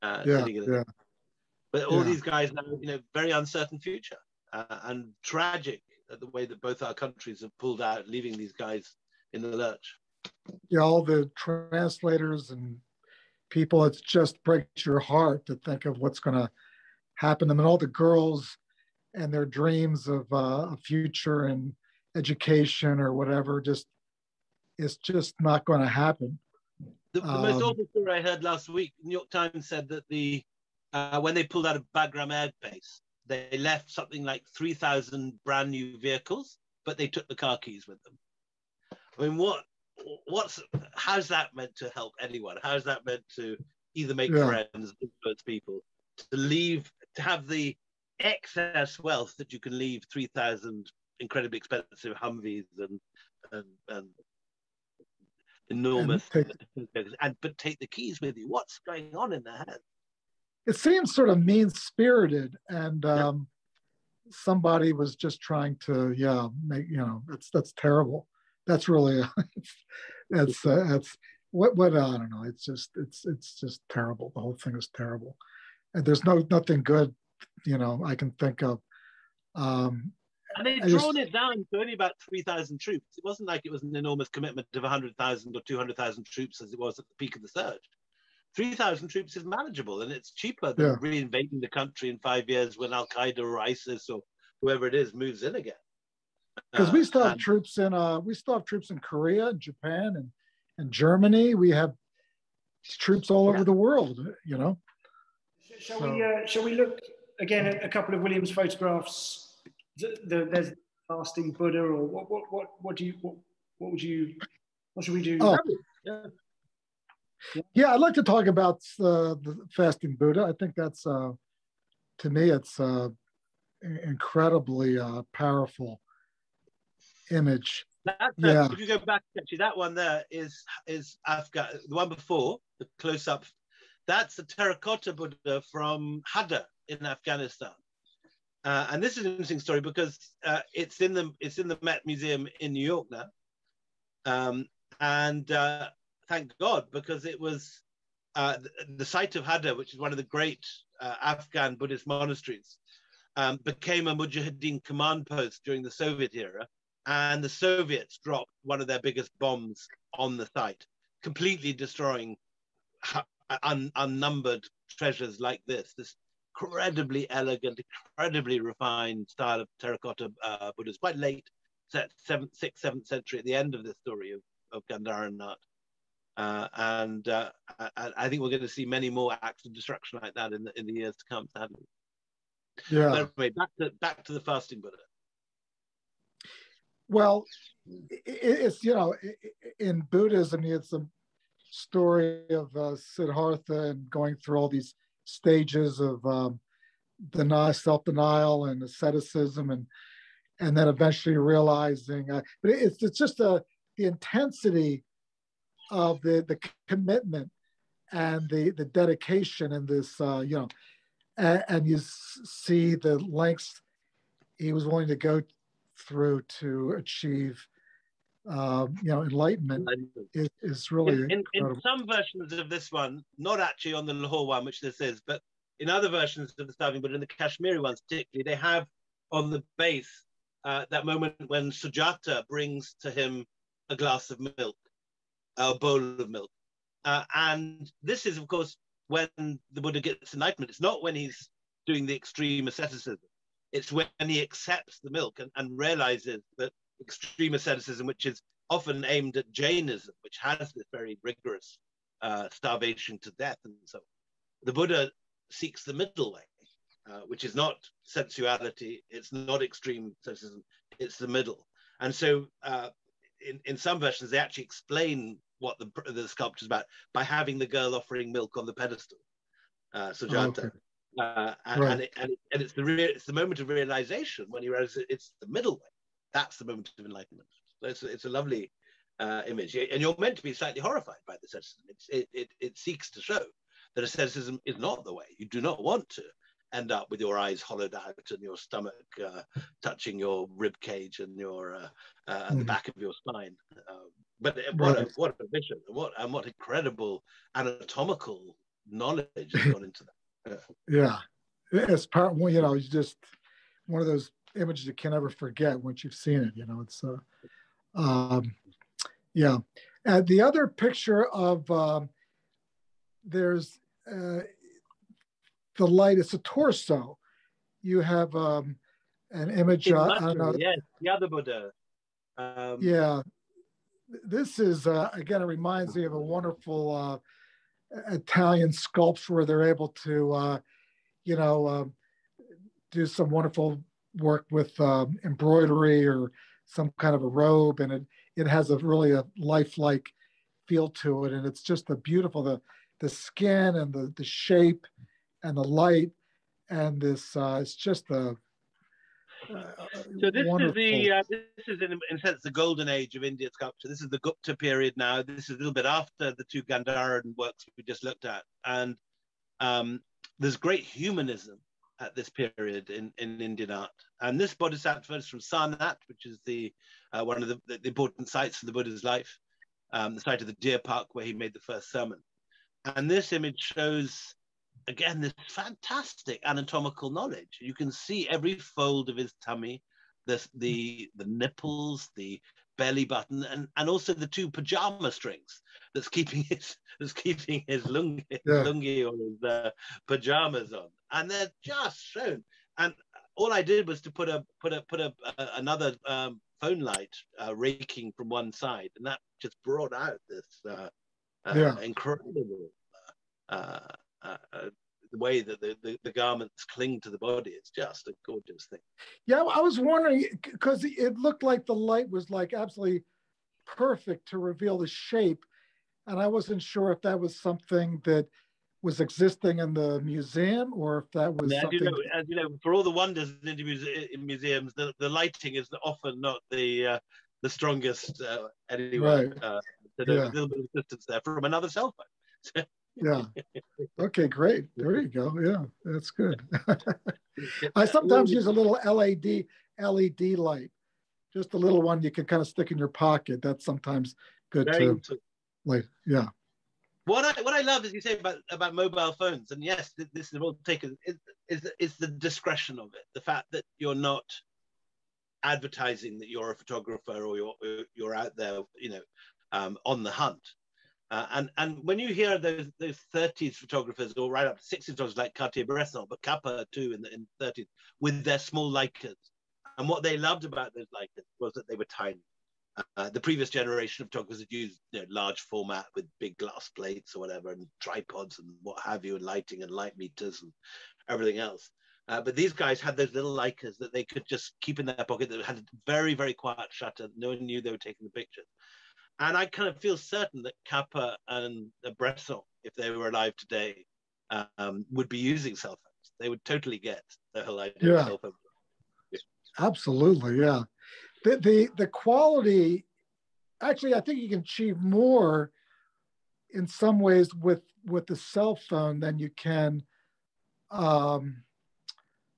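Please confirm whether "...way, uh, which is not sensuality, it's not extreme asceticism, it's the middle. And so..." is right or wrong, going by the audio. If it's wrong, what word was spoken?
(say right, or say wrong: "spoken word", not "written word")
right.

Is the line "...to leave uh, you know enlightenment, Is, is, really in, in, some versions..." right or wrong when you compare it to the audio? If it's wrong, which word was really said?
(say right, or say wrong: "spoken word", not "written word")
wrong: "achieve", not "leave".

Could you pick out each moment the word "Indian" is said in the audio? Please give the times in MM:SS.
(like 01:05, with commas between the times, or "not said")
05:53, 06:03.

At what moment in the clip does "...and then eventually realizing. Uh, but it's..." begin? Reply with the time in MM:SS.
03:20.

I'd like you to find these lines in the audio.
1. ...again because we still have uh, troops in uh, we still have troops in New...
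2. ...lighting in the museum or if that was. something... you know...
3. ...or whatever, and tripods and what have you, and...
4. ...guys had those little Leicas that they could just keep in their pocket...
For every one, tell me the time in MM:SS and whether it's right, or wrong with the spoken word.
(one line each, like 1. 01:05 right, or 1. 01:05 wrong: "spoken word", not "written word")
1. 01:35 wrong: "Korea", not "New"
2. 06:59 wrong: "existing", not "lighting"
3. 07:57 right
4. 08:02 right.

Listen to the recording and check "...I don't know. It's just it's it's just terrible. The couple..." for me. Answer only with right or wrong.
wrong.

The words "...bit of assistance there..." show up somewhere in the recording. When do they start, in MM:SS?
07:10.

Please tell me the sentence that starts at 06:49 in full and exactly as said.
Yeah, I was wondering because it looked like the light was like absolutely perfect to reveal the shape.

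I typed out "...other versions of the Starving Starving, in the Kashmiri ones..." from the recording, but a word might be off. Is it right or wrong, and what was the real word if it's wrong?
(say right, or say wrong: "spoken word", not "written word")
wrong: "Buddha", not "Starving".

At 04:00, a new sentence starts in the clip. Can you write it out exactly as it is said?
It's not when he's doing the extreme asceticism.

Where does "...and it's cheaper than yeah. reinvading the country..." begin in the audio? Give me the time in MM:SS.
01:30.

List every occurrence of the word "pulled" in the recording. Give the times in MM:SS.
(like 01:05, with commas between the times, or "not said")
00:07, 00:31.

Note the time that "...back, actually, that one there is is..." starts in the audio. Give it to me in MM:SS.
02:08.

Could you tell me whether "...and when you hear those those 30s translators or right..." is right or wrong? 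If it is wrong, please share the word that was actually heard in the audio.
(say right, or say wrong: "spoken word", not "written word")
wrong: "photographers", not "translators".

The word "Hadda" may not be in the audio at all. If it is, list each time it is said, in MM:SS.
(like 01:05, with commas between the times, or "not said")
02:16, 02:29.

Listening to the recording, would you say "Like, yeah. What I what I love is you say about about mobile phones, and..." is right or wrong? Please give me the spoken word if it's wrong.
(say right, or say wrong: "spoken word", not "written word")
right.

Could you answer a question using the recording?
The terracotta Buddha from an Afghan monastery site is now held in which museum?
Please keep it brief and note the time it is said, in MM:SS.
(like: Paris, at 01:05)
The Met Museum, at 02:21.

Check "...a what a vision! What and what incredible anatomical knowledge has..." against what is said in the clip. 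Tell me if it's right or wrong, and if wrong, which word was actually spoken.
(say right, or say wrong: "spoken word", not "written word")
right.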